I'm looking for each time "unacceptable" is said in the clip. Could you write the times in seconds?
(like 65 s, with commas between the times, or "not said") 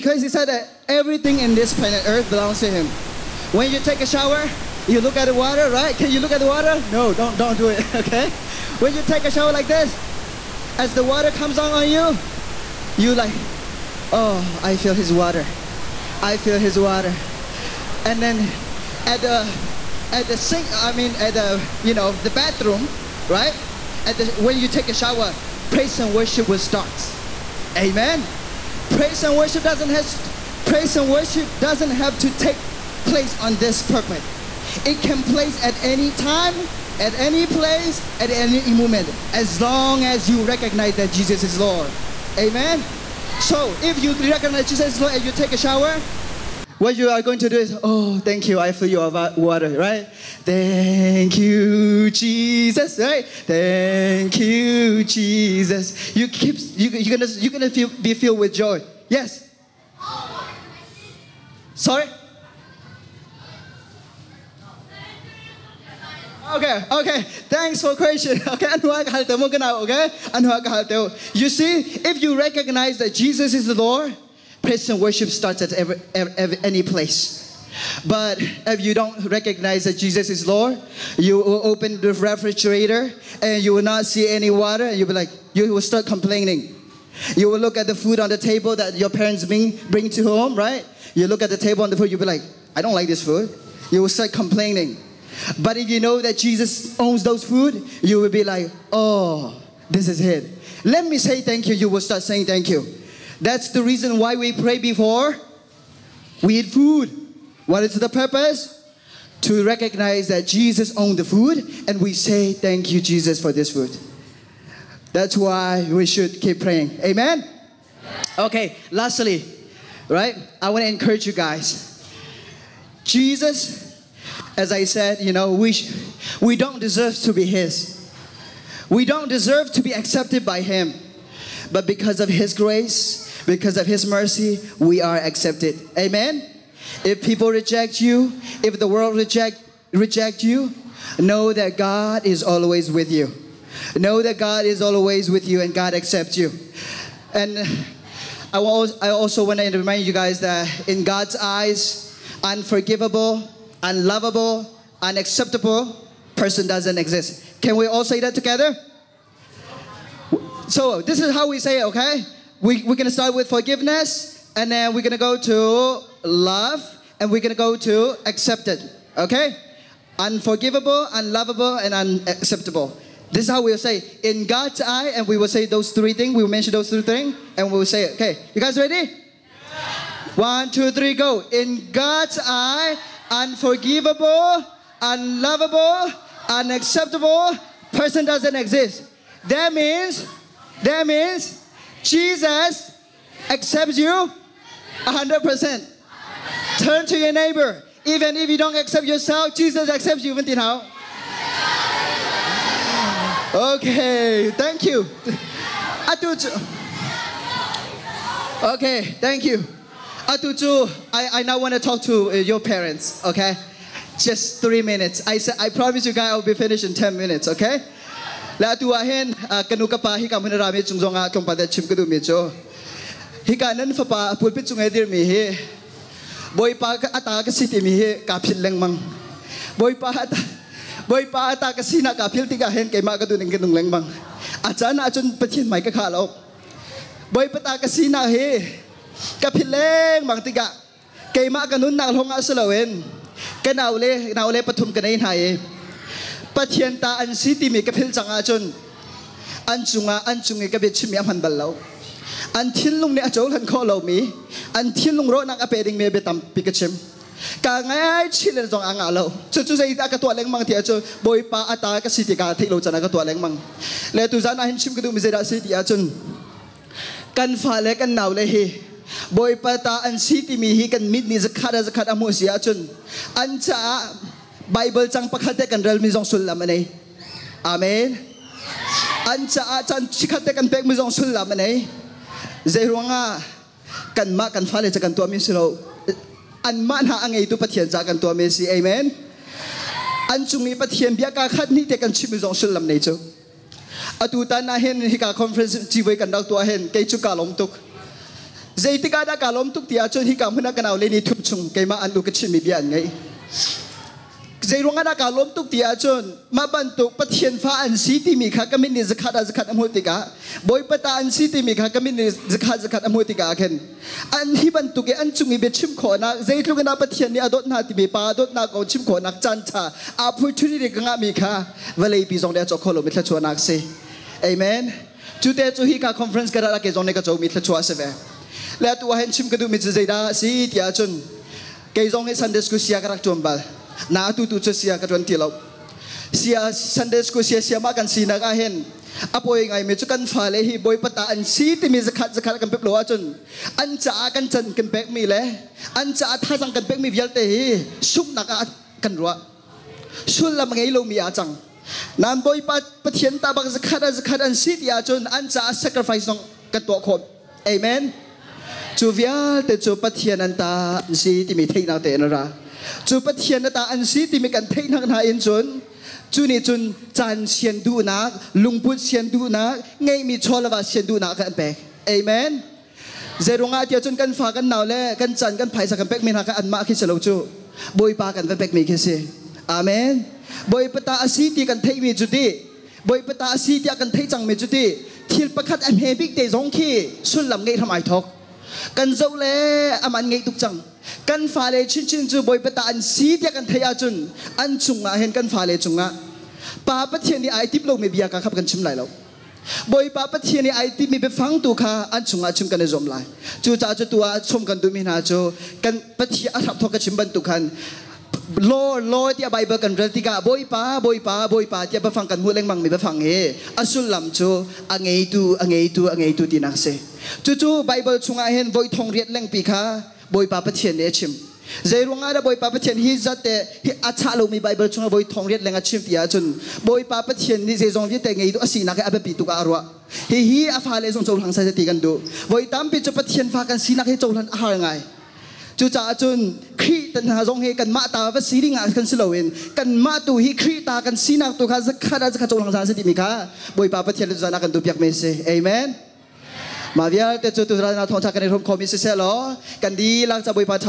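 155 s, 171 s, 186 s.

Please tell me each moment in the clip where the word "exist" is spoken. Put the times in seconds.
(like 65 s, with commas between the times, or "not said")
156 s, 188 s.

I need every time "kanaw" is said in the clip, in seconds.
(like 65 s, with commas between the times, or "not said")
300 s.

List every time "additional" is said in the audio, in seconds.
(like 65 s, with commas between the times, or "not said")
not said.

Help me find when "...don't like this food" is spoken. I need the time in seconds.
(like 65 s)
92 s.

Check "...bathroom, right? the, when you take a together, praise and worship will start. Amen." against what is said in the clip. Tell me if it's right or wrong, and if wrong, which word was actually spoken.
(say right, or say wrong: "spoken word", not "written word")
wrong: "shower", not "together".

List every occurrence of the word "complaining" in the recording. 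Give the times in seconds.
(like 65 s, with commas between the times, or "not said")
86 s, 94 s.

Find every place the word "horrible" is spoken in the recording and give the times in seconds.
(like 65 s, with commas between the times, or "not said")
not said.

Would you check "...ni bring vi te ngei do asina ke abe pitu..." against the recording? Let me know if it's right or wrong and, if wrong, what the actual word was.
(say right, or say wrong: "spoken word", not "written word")
wrong: "zejong", not "bring".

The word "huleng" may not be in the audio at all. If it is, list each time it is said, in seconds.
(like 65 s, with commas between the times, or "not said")
412 s.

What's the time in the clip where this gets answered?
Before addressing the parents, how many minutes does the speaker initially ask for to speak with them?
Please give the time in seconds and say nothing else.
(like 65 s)
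214 s.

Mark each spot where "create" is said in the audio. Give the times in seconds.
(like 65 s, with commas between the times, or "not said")
not said.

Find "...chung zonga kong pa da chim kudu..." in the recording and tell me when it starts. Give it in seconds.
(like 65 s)
220 s.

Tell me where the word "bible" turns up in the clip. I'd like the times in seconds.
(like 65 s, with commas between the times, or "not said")
274 s, 409 s, 417 s, 424 s.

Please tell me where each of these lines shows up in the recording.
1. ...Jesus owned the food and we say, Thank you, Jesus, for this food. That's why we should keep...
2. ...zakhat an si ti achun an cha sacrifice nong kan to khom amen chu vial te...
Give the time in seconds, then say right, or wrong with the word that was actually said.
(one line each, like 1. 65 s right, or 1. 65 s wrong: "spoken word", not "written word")
1. 110 s right
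2. 354 s right.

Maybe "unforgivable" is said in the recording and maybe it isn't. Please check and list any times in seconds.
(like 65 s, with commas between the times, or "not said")
152 s, 170 s, 183 s.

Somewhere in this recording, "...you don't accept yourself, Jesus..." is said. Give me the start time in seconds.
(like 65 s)
198 s.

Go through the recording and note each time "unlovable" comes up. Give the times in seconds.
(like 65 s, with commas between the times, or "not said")
153 s, 171 s, 185 s.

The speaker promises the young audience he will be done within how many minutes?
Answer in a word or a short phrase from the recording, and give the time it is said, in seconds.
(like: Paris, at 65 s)
10, at 216 s.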